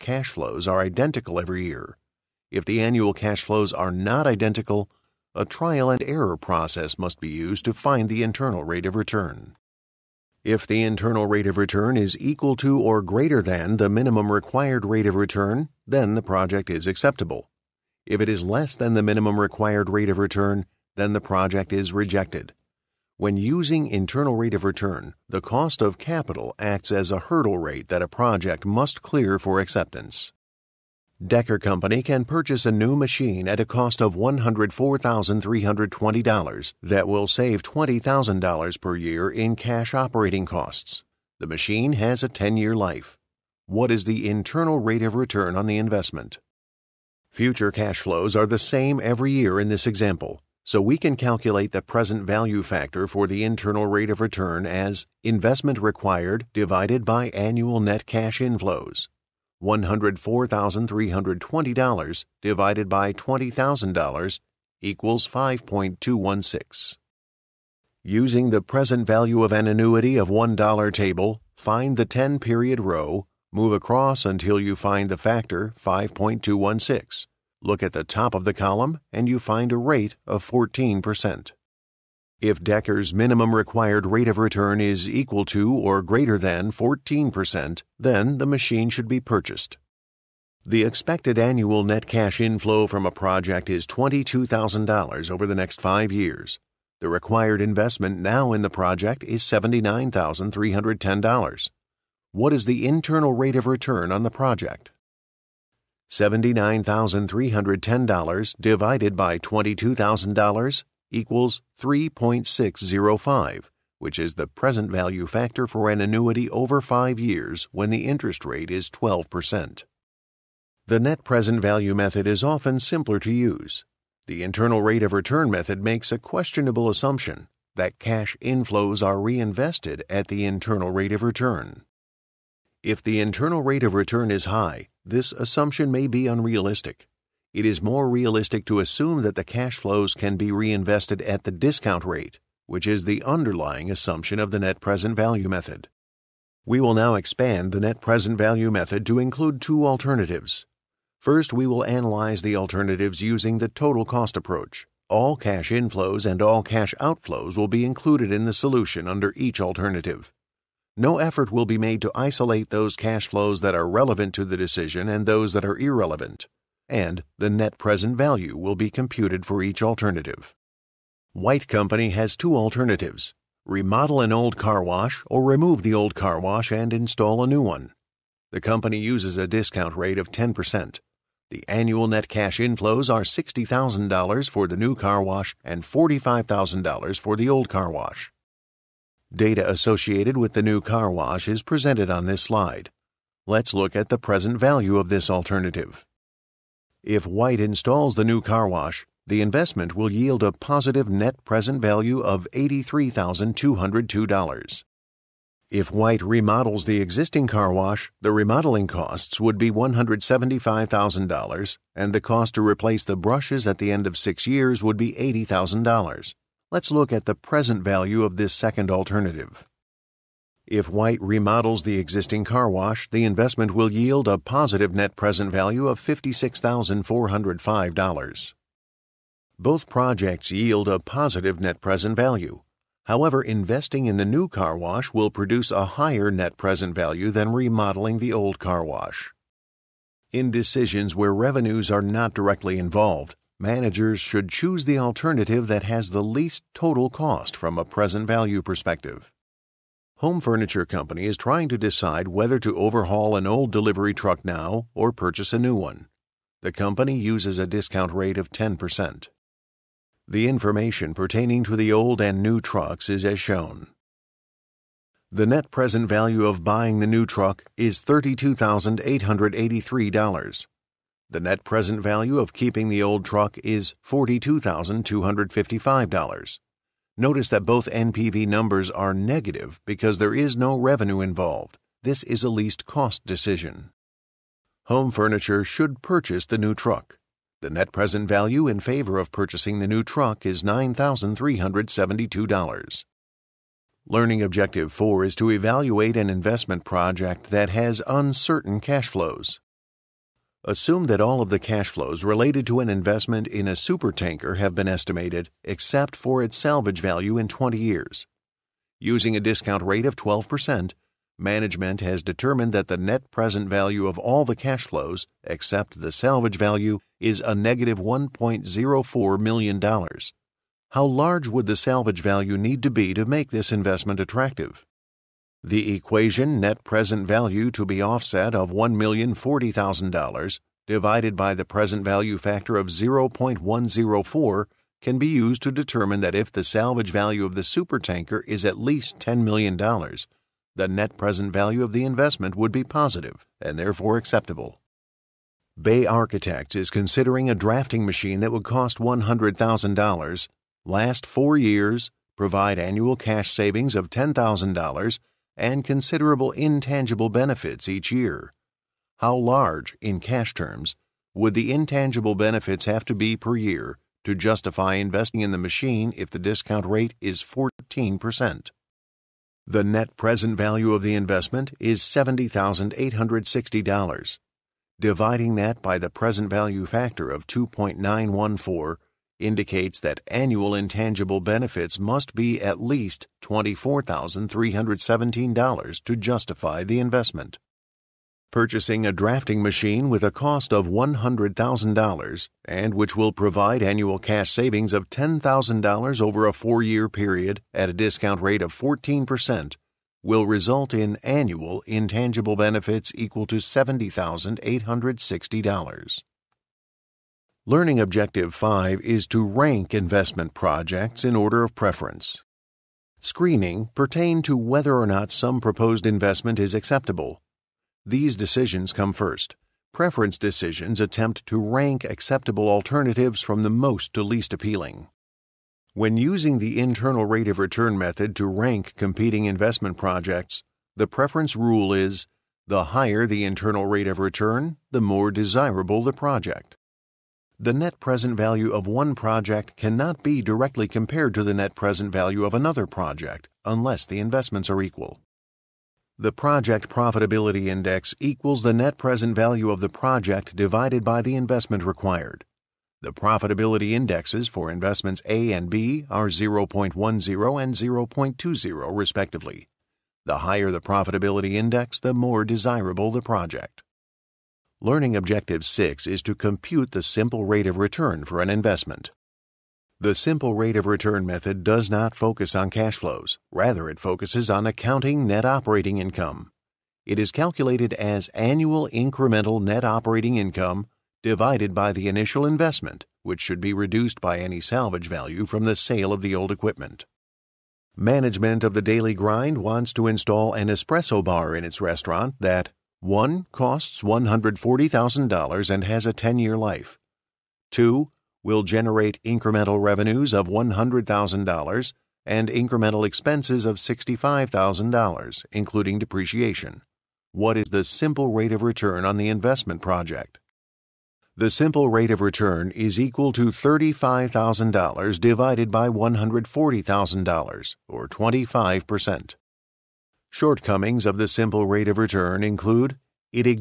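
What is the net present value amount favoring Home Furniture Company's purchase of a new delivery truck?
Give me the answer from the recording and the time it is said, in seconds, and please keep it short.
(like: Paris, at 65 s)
$9,372, at 290 s.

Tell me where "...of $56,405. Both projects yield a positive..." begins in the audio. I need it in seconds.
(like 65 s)
225 s.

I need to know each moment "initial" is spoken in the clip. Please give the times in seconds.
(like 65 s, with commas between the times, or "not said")
482 s.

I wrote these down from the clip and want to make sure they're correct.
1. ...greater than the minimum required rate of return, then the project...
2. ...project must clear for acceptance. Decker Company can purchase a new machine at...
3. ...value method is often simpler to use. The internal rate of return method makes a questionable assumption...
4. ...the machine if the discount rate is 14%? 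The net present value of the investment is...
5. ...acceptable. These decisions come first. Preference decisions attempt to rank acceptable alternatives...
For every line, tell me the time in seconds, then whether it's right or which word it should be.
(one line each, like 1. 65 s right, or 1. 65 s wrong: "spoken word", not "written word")
1. 13 s right
2. 28 s right
3. 121 s right
4. 365 s right
5. 416 s right.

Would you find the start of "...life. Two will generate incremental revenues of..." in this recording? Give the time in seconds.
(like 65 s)
496 s.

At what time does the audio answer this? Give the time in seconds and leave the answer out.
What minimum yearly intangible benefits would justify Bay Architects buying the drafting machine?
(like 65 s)
383 s.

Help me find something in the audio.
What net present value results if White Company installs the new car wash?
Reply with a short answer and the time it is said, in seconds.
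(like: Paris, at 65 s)
$83,202, at 202 s.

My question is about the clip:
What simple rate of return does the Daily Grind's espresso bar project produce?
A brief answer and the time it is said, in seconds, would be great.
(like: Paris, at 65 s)
25%, at 518 s.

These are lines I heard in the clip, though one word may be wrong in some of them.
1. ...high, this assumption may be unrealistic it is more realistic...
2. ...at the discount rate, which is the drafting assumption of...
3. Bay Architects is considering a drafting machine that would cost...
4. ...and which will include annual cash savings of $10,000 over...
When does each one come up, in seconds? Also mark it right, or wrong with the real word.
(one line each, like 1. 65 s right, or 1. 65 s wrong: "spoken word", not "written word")
1. 134 s right
2. 141 s wrong: "underlying", not "drafting"
3. 345 s right
4. 392 s wrong: "provide", not "include".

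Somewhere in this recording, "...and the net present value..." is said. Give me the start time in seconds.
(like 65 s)
166 s.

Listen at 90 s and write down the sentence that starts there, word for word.
The expected annual net cash inflow from a project is $22,000 over the next five years.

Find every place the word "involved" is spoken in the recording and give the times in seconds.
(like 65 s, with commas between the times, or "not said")
242 s, 281 s.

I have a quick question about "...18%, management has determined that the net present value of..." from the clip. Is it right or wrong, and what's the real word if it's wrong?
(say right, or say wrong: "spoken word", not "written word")
wrong: "12", not "18".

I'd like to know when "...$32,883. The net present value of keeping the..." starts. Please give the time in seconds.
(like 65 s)
268 s.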